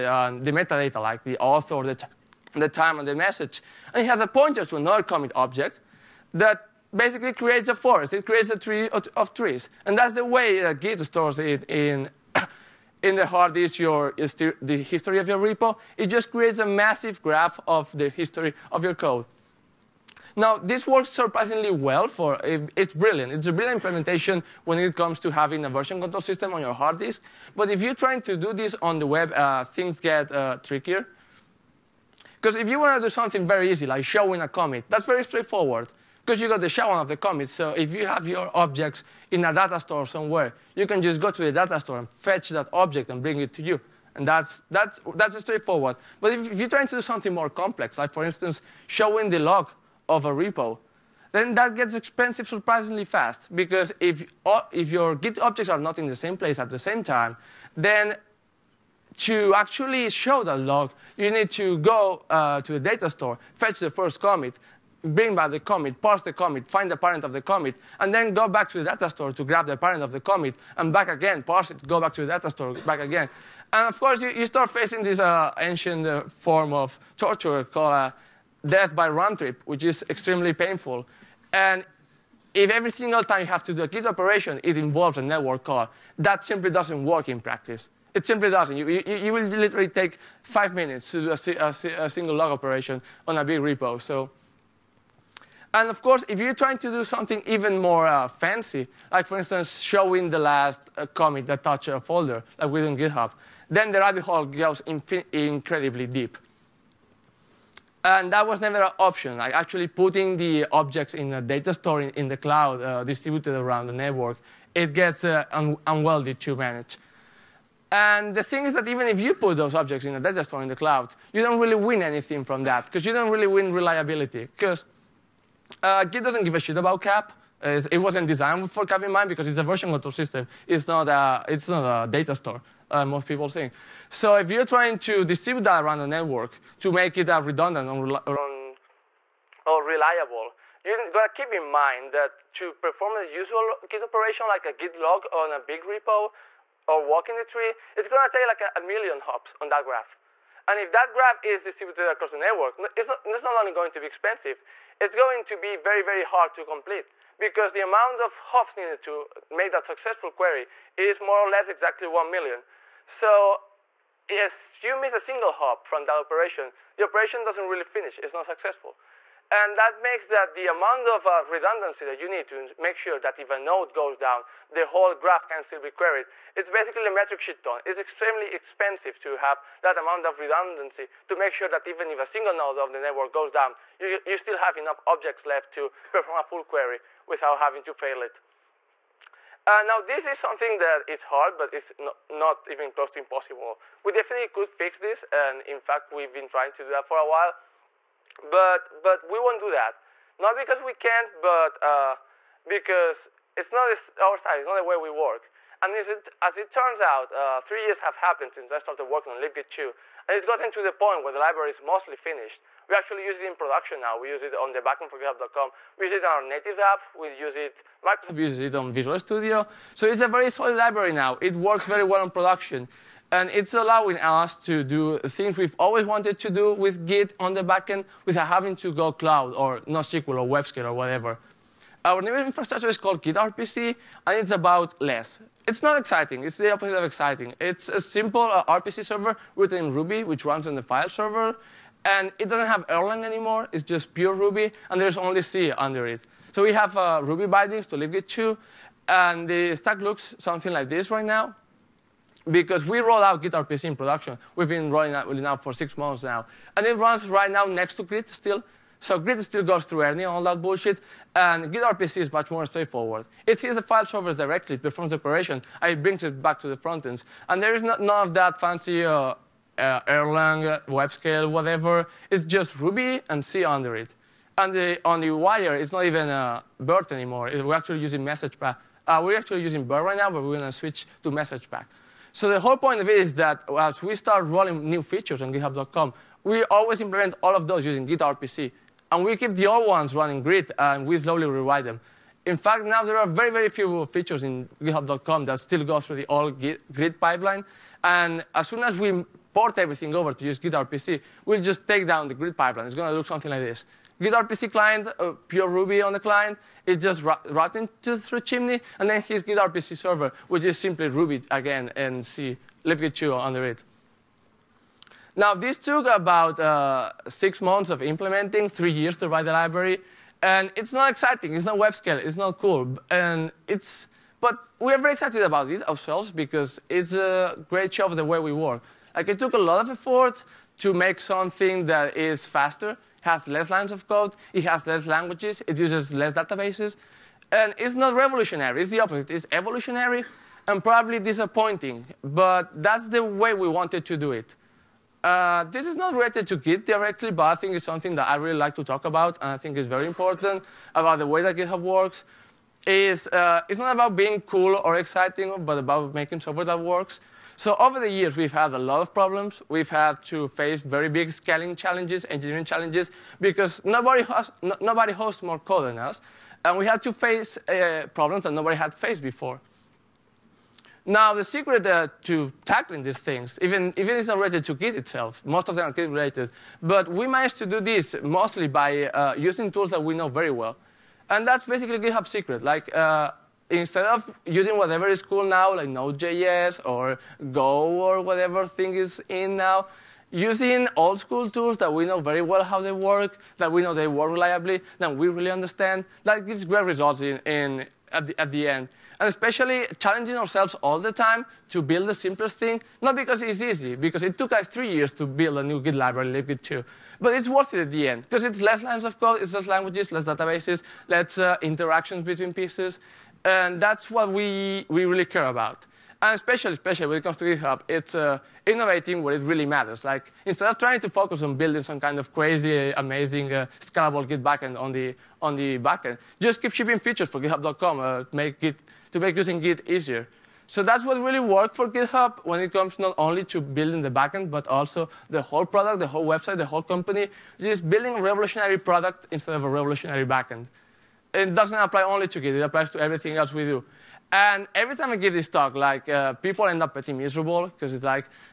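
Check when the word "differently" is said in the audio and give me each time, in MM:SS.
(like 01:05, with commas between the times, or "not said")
not said.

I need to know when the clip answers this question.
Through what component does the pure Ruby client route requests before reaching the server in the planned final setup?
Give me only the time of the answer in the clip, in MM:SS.
05:08.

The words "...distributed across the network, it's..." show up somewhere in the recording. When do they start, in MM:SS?
02:31.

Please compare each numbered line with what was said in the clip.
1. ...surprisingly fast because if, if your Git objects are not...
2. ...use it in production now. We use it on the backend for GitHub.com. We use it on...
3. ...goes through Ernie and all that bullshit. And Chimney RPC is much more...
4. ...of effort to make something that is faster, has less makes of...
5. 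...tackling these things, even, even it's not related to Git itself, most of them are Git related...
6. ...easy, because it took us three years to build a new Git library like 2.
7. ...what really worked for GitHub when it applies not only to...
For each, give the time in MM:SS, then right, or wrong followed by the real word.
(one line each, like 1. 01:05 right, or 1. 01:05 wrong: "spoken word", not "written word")
1. 00:52 right
2. 03:33 right
3. 04:19 wrong: "Git", not "Chimney"
4. 05:29 wrong: "lines", not "makes"
5. 06:12 right
6. 06:43 right
7. 07:11 wrong: "comes", not "applies".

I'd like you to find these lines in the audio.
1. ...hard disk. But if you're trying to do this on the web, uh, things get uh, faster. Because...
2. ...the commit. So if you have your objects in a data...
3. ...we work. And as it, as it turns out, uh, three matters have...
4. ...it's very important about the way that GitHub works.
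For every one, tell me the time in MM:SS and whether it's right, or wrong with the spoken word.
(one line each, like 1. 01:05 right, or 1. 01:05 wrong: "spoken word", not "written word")
1. 00:26 wrong: "trickier", not "faster"
2. 00:37 right
3. 03:24 wrong: "years", not "matters"
4. 05:49 right.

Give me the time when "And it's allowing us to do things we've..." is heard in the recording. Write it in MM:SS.
03:43.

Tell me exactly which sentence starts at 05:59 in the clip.
We've had to face very big scaling challenges, engineering challenges, because nobody, has, no, nobody hosts more code than us.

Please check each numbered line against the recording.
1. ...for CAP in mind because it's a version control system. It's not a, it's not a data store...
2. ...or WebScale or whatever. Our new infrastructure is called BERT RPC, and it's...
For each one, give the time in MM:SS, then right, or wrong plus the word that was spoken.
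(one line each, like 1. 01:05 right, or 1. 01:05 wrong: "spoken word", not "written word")
1. 02:08 right
2. 03:50 wrong: "Git", not "BERT".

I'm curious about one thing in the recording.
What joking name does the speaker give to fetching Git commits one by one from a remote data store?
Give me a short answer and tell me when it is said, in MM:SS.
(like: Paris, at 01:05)
death by round trip, at 01:18.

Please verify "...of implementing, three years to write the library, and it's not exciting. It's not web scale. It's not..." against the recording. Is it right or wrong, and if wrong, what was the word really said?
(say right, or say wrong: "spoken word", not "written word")
right.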